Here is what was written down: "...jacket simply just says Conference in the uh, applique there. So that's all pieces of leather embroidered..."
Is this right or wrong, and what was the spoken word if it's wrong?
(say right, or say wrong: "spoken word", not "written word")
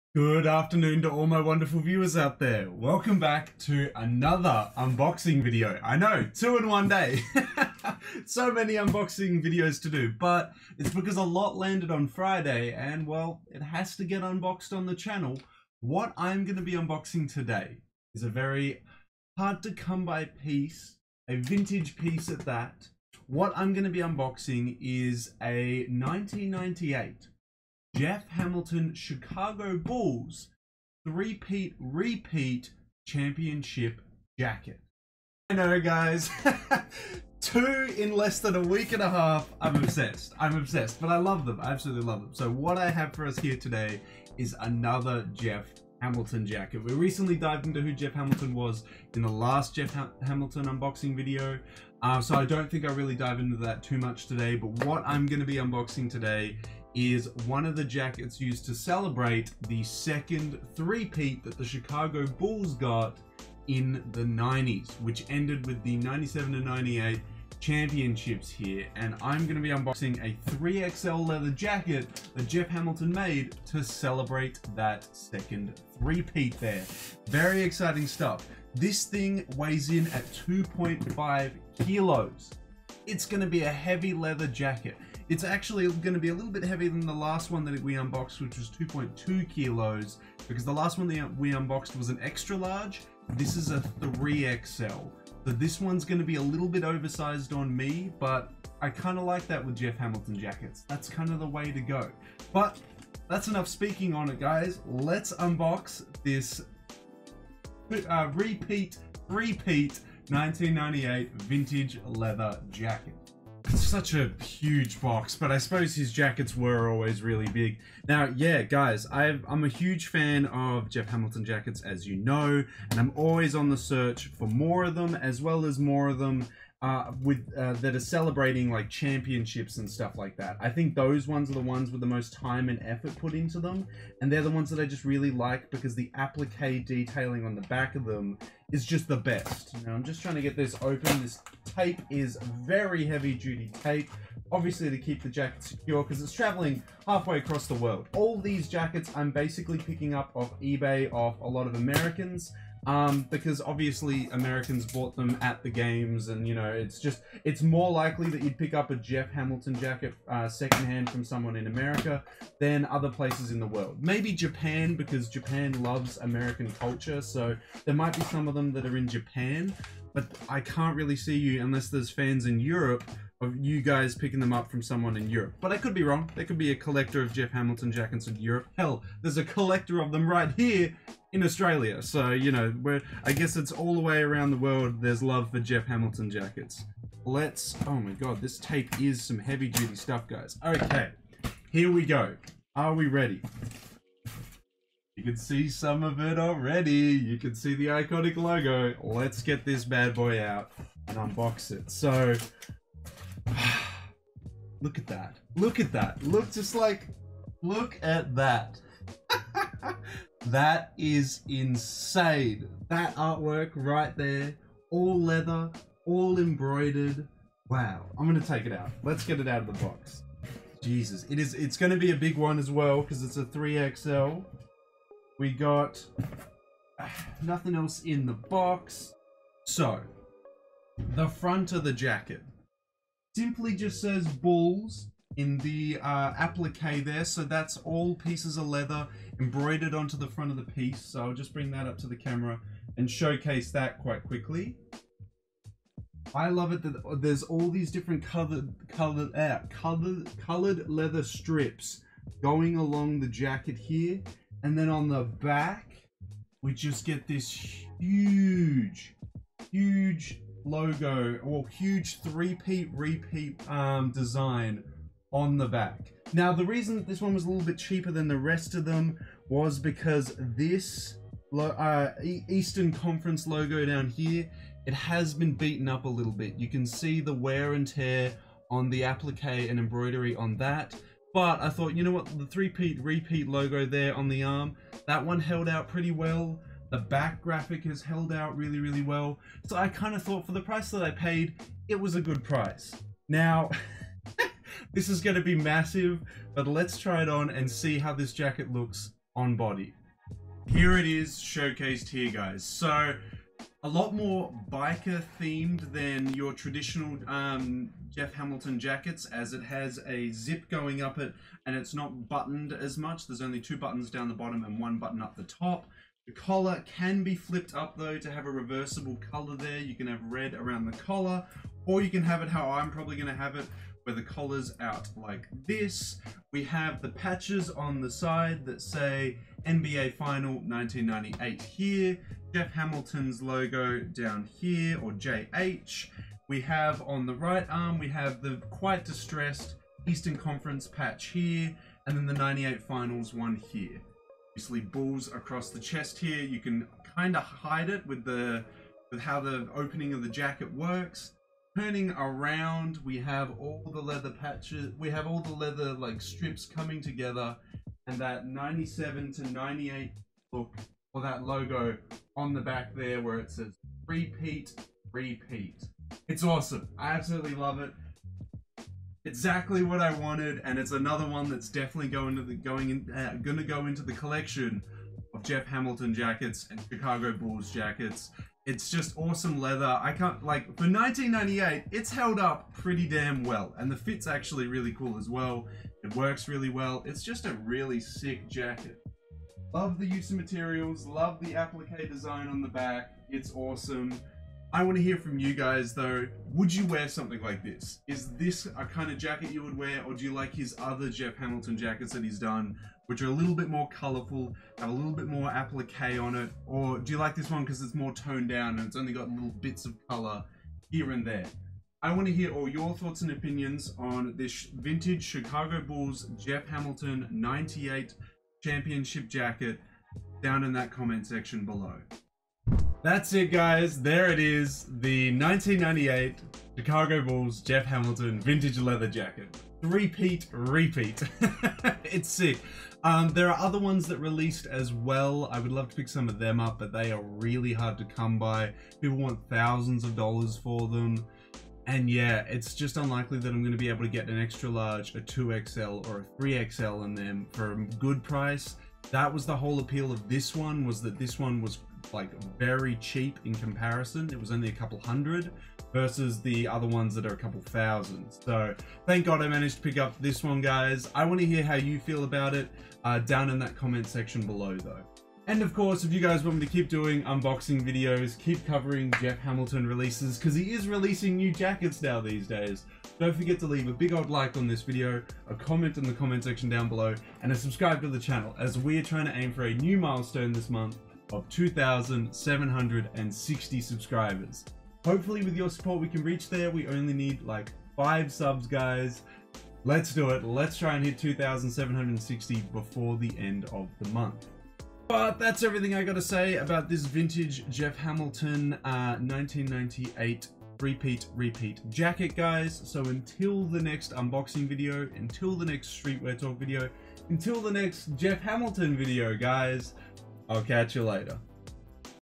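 wrong: "Bulls", not "Conference".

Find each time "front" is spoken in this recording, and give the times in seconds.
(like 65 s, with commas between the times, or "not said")
231 s, 240 s.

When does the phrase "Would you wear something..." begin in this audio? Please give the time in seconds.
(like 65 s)
396 s.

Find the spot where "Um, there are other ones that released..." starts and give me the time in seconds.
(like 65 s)
433 s.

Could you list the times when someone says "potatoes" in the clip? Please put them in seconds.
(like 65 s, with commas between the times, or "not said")
not said.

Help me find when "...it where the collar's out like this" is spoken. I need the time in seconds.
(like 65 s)
323 s.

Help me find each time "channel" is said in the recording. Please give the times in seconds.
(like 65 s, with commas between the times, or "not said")
14 s, 478 s.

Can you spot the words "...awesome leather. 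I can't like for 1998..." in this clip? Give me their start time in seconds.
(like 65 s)
379 s.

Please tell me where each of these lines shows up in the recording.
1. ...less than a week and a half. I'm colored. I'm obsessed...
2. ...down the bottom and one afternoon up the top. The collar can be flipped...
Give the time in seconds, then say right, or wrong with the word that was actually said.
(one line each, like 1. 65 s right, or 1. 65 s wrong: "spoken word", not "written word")
1. 38 s wrong: "obsessed", not "colored"
2. 314 s wrong: "button", not "afternoon".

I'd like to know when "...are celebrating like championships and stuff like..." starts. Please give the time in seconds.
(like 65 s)
127 s.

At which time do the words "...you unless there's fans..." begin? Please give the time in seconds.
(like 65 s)
171 s.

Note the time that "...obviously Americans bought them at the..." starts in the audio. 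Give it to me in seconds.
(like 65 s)
153 s.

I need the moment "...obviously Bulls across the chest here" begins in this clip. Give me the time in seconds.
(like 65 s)
344 s.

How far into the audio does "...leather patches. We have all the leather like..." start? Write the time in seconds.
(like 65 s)
354 s.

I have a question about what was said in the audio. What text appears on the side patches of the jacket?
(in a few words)
NBA Final 1998.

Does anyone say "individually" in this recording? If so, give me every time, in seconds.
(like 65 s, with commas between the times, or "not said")
not said.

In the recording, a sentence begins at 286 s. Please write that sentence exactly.
The back graphic has held out really, really well.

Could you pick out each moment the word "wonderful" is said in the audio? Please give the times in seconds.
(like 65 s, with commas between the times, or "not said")
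1 s.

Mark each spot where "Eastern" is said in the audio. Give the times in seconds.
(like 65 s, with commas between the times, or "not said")
272 s, 340 s.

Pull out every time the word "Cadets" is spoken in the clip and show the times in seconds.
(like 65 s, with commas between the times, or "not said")
not said.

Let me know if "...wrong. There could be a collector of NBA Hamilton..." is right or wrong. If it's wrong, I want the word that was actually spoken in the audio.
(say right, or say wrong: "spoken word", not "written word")
wrong: "Jeff", not "NBA".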